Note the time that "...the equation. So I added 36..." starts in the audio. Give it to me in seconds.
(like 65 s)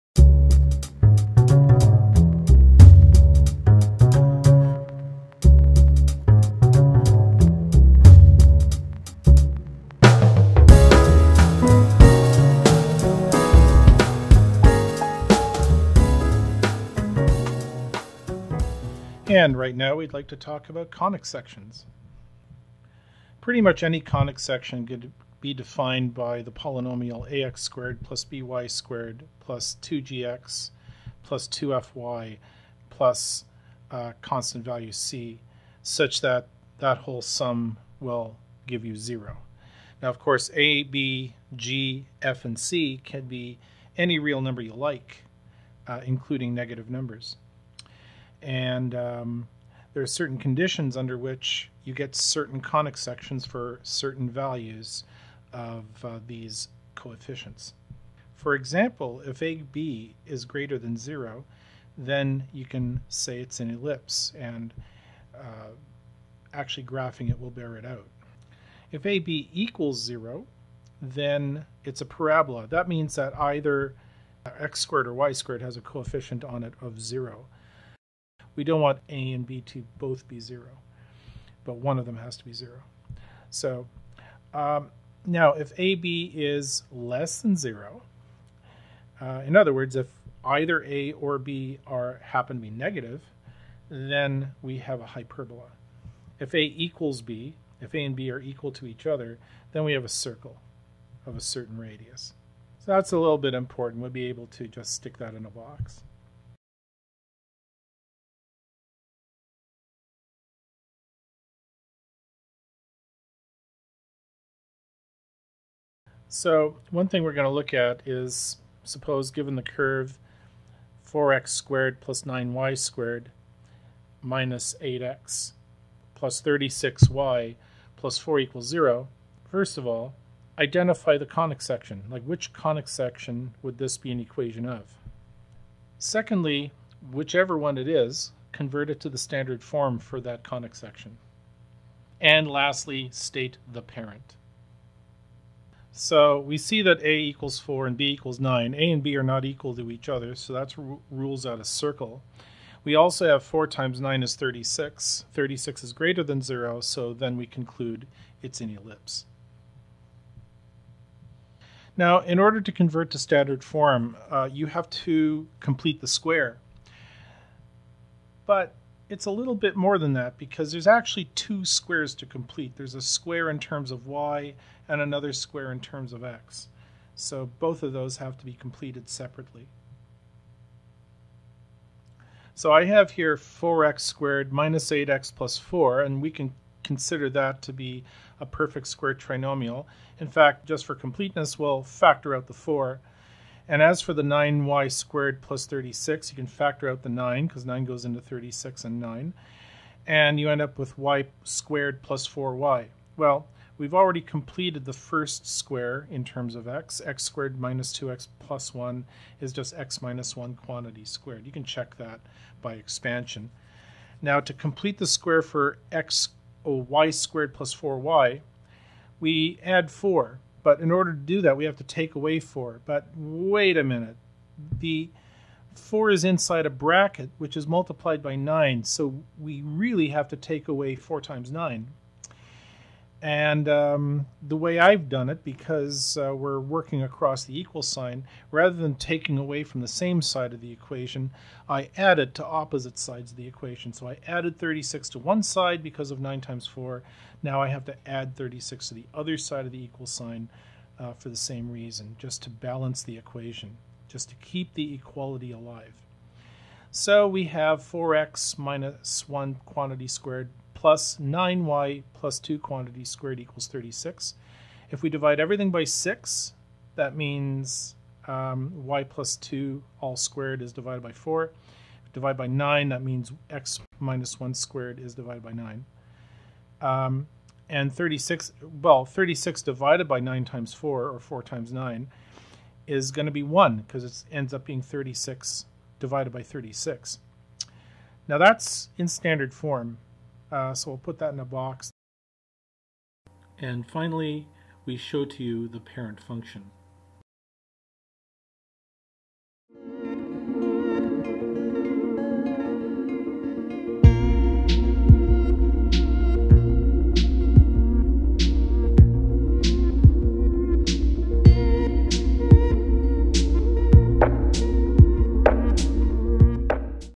243 s.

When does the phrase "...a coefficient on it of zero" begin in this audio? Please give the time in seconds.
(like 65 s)
75 s.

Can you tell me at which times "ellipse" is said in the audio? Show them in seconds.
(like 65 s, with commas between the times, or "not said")
63 s, 158 s.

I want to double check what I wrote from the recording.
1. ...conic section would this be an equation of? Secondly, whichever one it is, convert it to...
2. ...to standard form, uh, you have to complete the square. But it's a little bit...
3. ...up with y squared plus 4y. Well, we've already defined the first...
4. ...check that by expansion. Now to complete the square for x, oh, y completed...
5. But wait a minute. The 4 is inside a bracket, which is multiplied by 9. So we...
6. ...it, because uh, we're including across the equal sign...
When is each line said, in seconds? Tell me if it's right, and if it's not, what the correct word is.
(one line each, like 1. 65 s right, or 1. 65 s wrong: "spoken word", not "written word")
1. 132 s right
2. 163 s right
3. 200 s wrong: "completed", not "defined"
4. 211 s wrong: "squared", not "completed"
5. 222 s right
6. 235 s wrong: "working", not "including".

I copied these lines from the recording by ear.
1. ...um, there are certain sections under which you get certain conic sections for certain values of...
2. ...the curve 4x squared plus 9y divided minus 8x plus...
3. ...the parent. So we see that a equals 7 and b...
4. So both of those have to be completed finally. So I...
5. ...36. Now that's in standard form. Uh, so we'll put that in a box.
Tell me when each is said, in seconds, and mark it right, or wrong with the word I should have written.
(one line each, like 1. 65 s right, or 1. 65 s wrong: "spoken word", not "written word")
1. 48 s wrong: "conditions", not "sections"
2. 119 s wrong: "squared", not "divided"
3. 143 s wrong: "4", not "7"
4. 177 s wrong: "separately", not "finally"
5. 286 s right.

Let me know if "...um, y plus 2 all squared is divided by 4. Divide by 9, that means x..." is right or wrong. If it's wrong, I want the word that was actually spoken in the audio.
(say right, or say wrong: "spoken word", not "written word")
right.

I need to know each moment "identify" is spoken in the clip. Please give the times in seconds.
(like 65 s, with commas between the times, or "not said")
130 s.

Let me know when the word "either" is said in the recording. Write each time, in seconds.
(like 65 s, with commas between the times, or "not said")
73 s, 90 s.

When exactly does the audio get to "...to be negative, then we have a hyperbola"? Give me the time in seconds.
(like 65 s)
92 s.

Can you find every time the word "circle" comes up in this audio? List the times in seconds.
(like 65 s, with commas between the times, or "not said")
100 s, 151 s.